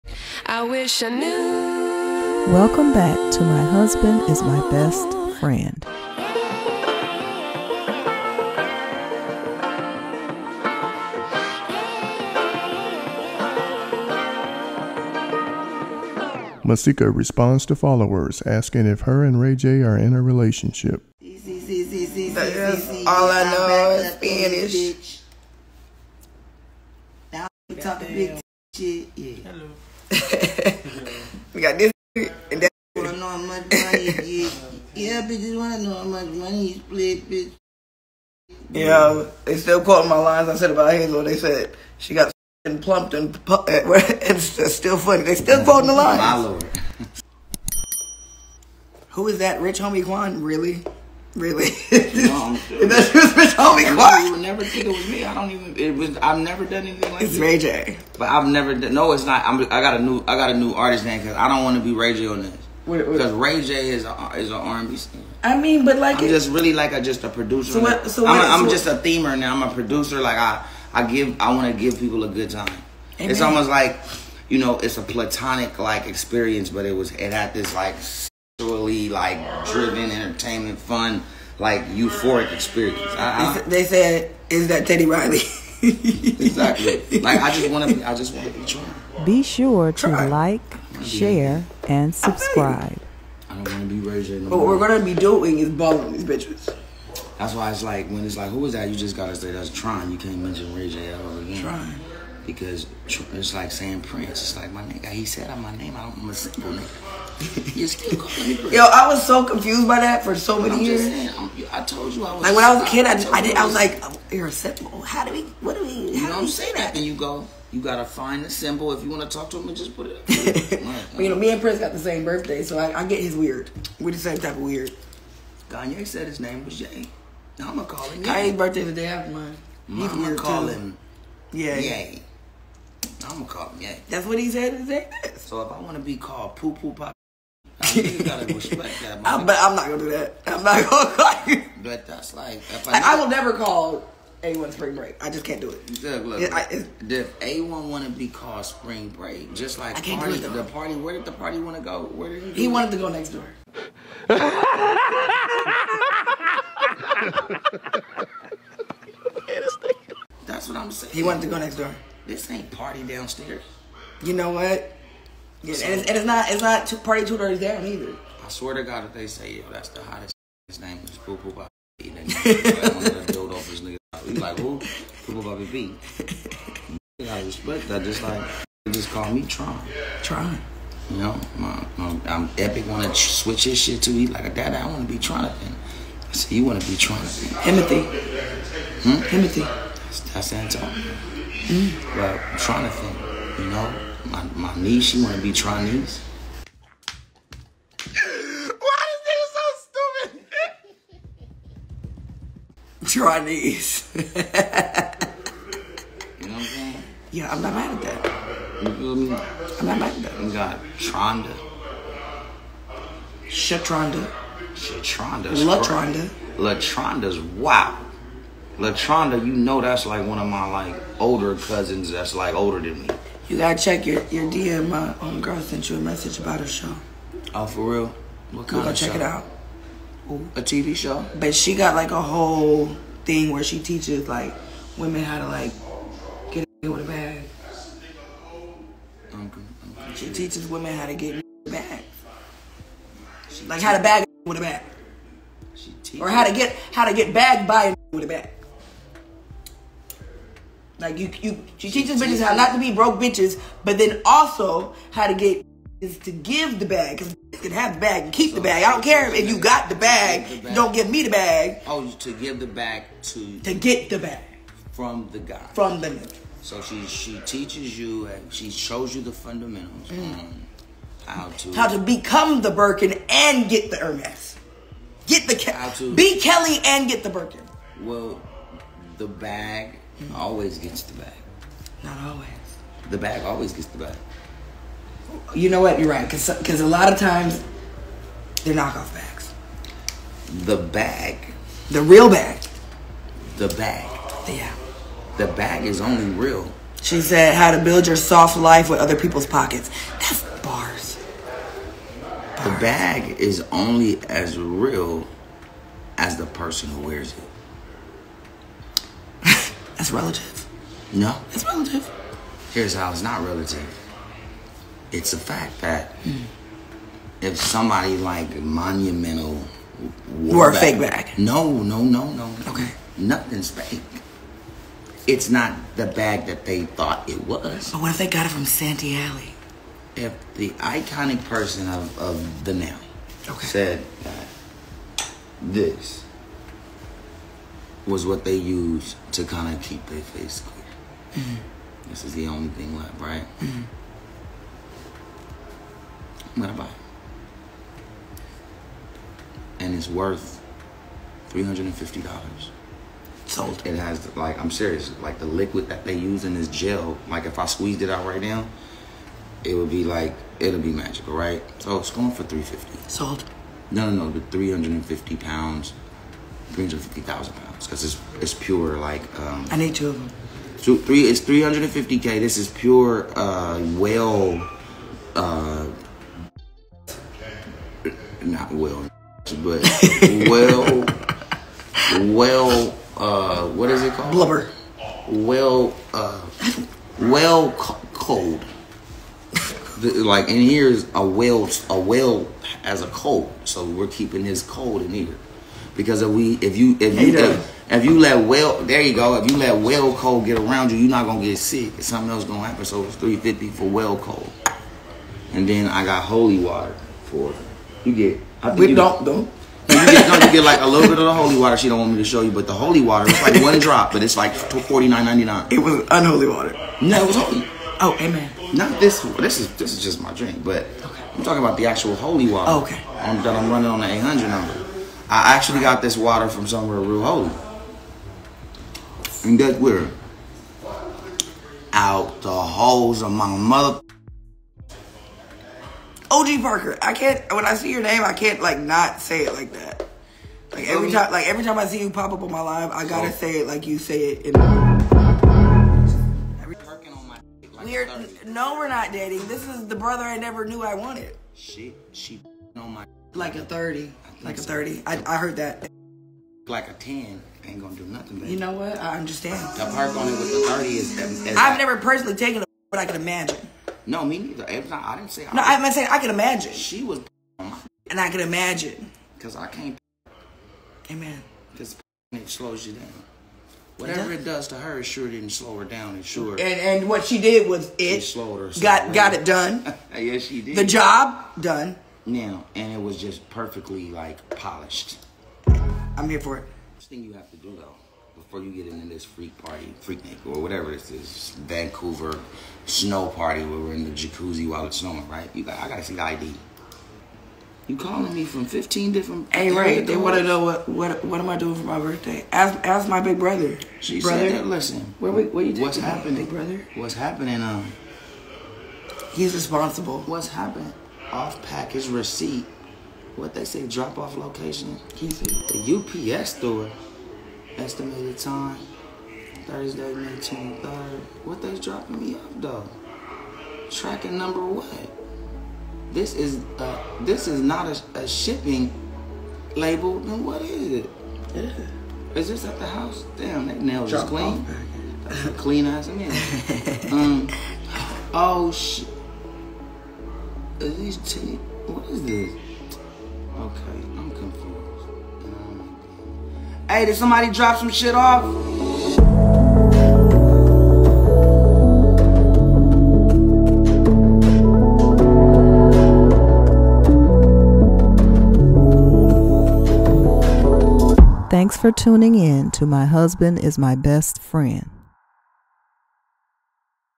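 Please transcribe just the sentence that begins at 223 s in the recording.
You gotta check your, your DM.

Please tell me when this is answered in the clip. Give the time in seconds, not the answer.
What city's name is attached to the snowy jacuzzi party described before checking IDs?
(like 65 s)
491 s.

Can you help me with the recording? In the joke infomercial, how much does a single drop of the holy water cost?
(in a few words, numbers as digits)
49.99.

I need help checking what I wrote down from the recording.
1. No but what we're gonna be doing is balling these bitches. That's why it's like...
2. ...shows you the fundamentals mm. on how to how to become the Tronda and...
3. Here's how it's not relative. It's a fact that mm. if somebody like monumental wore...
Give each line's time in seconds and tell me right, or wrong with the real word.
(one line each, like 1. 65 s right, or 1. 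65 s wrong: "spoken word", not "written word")
1. 94 s right
2. 268 s wrong: "Birkin", not "Tronda"
3. 312 s right.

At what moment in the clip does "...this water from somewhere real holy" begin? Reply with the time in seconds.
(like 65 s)
426 s.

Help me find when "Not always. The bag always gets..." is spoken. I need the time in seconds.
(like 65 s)
282 s.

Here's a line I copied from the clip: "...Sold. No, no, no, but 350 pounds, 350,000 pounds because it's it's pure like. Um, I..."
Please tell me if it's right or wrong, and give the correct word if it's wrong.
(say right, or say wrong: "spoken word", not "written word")
right.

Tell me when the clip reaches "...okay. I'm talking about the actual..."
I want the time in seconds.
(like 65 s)
421 s.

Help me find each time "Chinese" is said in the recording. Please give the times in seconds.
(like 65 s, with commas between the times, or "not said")
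195 s, 203 s.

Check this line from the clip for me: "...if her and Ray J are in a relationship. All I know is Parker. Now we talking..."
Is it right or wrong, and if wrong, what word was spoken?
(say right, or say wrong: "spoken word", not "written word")
wrong: "Spanish", not "Parker".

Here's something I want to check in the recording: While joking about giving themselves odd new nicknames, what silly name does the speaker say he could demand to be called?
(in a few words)
Poo Poo Pop.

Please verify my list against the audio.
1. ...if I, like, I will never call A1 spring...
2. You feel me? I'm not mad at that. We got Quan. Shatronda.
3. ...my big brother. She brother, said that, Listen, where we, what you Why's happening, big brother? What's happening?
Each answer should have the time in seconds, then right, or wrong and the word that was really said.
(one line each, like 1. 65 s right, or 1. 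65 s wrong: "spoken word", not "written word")
1. 142 s right
2. 208 s wrong: "Tronda", not "Quan"
3. 503 s wrong: "What", not "Why".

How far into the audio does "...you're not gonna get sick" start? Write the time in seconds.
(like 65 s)
400 s.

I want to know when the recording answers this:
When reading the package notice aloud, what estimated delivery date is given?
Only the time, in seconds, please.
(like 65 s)
519 s.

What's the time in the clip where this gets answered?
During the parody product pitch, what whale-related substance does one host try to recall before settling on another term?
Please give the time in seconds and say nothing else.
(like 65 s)
384 s.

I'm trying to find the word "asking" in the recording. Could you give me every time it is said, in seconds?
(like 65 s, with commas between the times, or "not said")
18 s.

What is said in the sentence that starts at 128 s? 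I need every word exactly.
Kanye's birthday the day after mine.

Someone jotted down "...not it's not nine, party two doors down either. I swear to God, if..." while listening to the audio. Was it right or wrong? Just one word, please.
wrong.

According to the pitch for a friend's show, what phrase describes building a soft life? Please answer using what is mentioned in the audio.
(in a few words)
with other people's pockets.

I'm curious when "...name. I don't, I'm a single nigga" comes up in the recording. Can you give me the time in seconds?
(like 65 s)
105 s.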